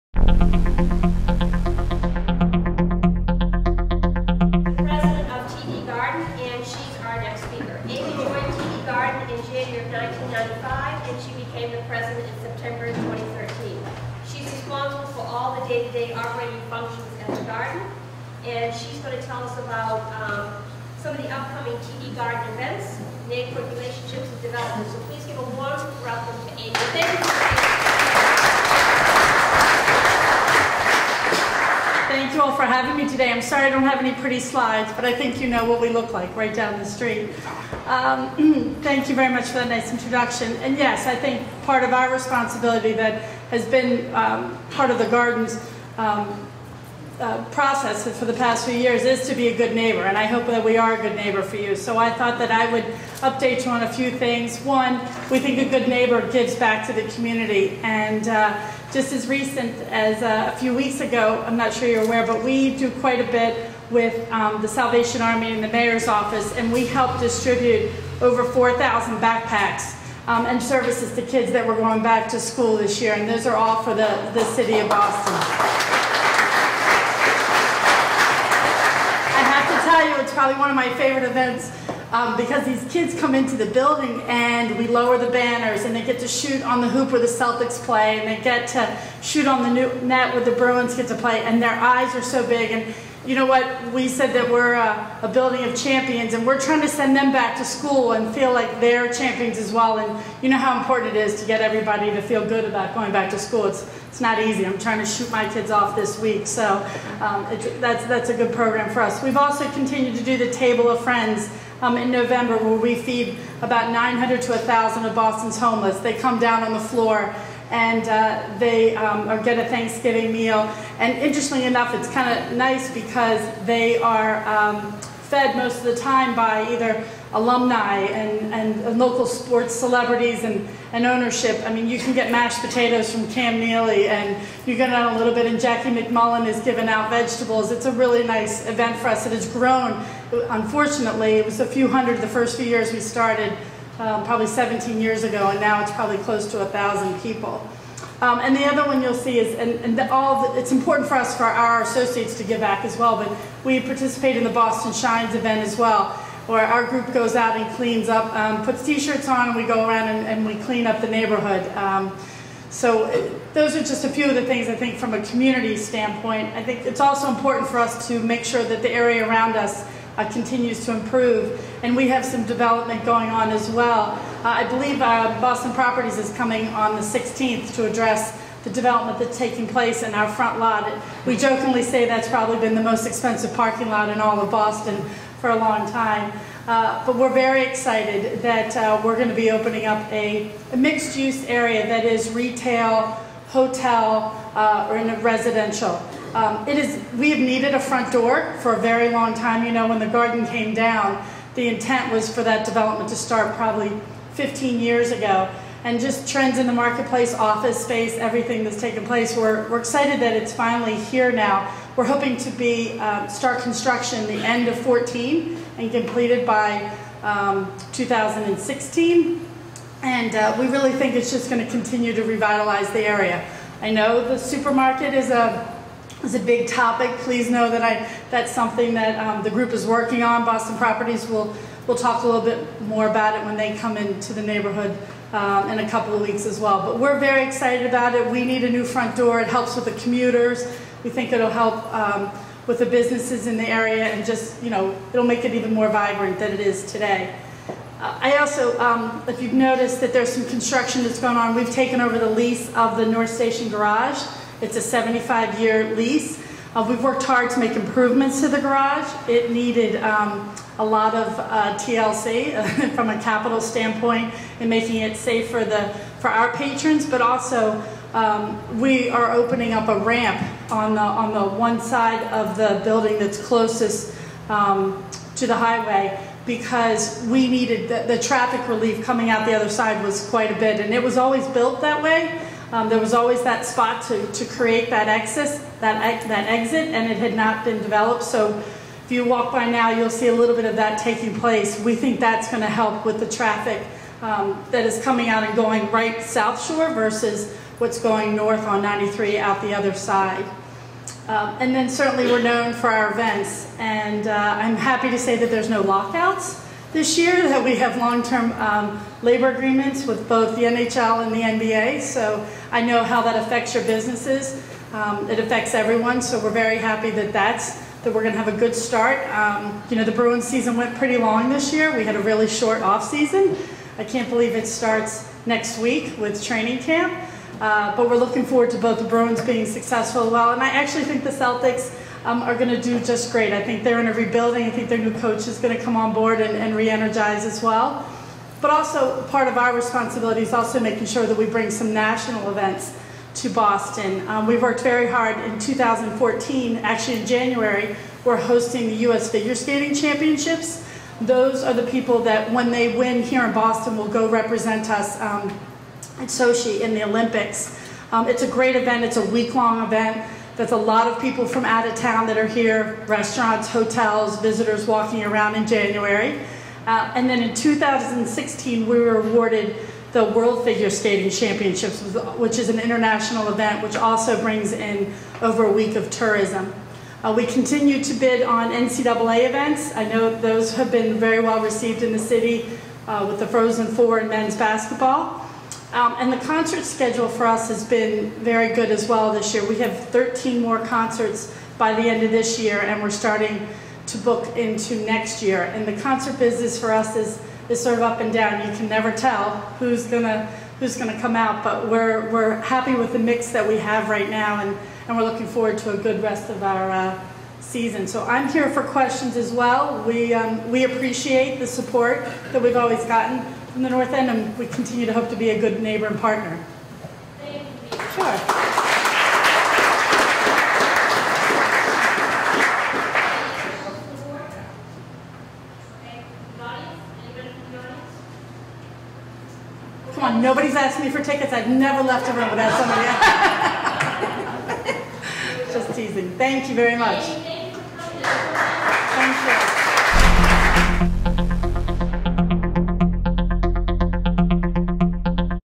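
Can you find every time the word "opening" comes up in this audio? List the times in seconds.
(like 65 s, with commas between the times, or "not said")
189 s, 269 s.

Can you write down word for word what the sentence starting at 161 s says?
Um, so it, uh, those are just a few of the things I think from a community standpoint.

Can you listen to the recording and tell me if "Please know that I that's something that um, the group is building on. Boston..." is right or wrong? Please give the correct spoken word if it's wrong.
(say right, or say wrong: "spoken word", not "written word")
wrong: "working", not "building".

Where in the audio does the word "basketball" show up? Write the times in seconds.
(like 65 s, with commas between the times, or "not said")
384 s.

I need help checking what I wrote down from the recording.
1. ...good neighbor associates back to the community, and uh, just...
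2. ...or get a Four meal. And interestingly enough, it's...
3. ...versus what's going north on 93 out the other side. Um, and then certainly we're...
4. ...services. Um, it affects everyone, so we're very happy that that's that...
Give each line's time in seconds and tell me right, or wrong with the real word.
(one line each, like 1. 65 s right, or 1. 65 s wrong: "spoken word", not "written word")
1. 55 s wrong: "gives", not "associates"
2. 119 s wrong: "Thanksgiving", not "Four"
3. 296 s right
4. 313 s wrong: "businesses", not "services".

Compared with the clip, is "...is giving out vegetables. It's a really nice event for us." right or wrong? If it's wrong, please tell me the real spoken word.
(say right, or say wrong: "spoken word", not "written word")
right.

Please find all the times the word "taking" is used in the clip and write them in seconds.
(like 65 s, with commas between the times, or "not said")
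179 s, 290 s.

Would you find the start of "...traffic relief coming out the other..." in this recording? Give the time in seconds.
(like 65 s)
278 s.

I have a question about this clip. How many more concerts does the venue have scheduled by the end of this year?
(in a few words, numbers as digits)
13.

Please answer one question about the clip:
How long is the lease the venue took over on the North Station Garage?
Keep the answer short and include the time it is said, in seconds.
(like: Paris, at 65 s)
75 years, at 254 s.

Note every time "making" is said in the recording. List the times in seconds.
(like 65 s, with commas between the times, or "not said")
264 s, 340 s.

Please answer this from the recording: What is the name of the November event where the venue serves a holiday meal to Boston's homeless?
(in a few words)
Table of Friends.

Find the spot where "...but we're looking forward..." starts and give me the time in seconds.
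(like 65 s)
327 s.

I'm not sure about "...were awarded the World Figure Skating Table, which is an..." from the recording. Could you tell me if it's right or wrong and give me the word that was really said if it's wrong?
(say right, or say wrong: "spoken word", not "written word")
wrong: "Championships", not "Table".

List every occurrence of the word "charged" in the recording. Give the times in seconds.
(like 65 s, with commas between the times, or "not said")
not said.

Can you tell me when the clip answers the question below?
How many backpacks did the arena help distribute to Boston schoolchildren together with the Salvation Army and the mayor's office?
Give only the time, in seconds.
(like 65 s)
68 s.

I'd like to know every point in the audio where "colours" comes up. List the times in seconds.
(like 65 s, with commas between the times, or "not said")
not said.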